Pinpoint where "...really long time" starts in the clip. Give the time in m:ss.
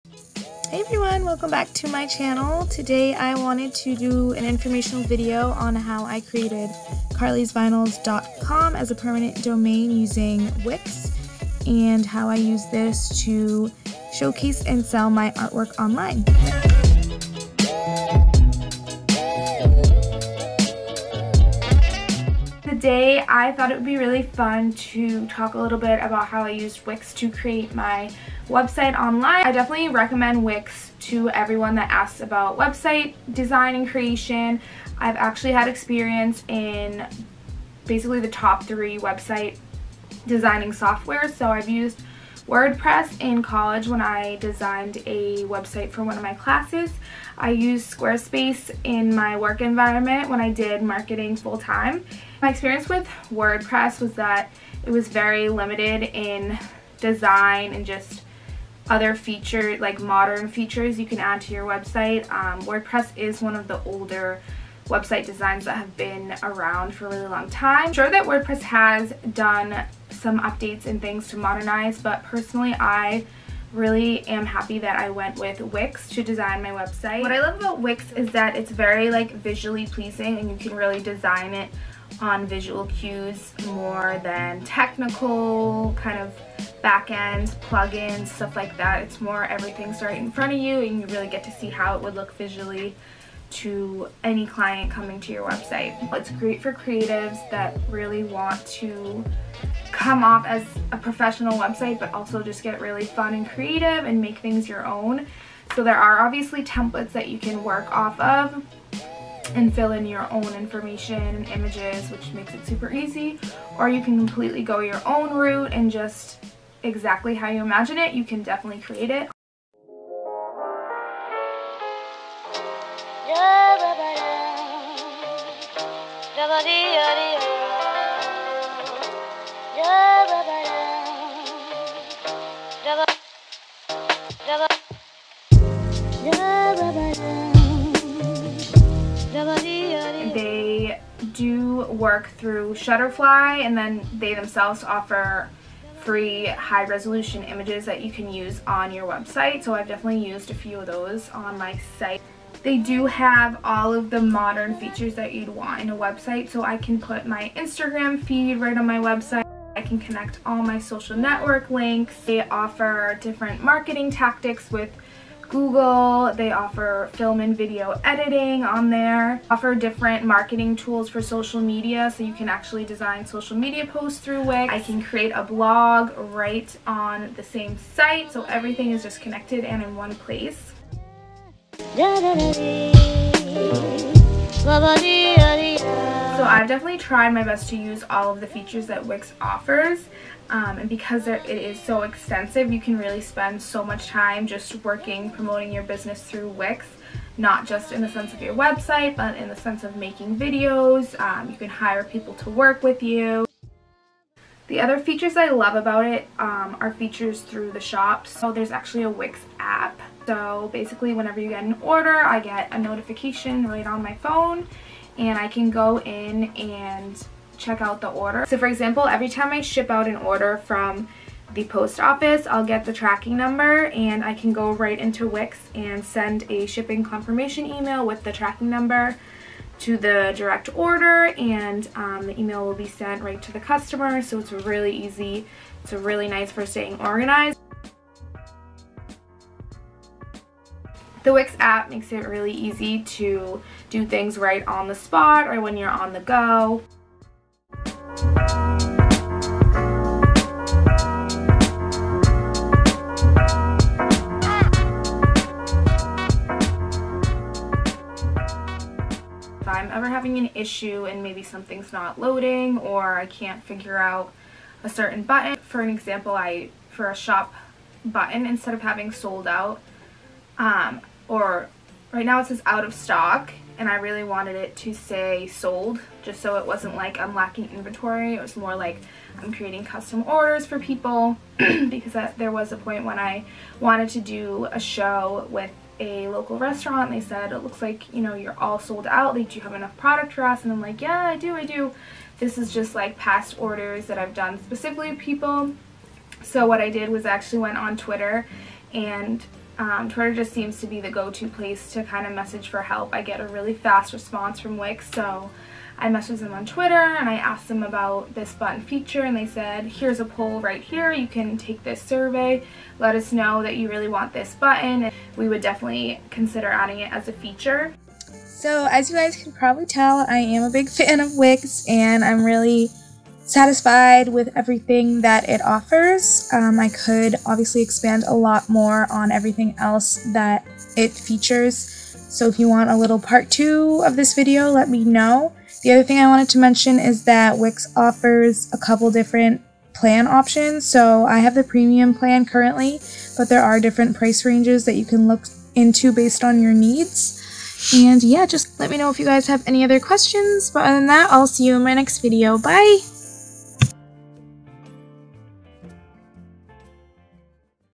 1:07.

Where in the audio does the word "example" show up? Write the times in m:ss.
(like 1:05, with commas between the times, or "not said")
3:38, 4:25.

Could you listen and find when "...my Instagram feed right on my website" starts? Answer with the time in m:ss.
2:37.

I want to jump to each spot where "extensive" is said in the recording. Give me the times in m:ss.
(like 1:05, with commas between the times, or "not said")
3:12.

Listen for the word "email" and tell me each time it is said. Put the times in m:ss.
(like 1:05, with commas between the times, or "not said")
3:47, 3:52.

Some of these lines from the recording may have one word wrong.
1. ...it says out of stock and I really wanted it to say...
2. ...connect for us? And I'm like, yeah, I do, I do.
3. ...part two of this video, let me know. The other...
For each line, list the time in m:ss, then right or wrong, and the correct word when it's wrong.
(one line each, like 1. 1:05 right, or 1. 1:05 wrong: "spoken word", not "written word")
1. 4:32 right
2. 4:49 wrong: "product", not "connect"
3. 5:33 right.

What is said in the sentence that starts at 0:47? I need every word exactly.
I used Squarespace in my work environment when I did marketing full-time.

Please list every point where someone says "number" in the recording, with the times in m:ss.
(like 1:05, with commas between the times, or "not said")
3:43, 3:48.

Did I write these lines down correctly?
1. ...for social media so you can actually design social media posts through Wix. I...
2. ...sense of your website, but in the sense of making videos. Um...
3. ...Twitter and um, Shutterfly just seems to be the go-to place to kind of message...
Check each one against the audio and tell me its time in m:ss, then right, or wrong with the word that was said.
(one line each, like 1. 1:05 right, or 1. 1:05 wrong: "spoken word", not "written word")
1. 2:51 right
2. 3:18 right
3. 4:57 wrong: "Twitter", not "Shutterfly".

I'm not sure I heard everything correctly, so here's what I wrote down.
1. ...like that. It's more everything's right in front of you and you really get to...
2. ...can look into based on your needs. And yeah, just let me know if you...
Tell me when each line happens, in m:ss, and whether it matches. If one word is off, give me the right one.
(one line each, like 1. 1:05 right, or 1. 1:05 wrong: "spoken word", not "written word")
1. 1:28 right
2. 5:45 right.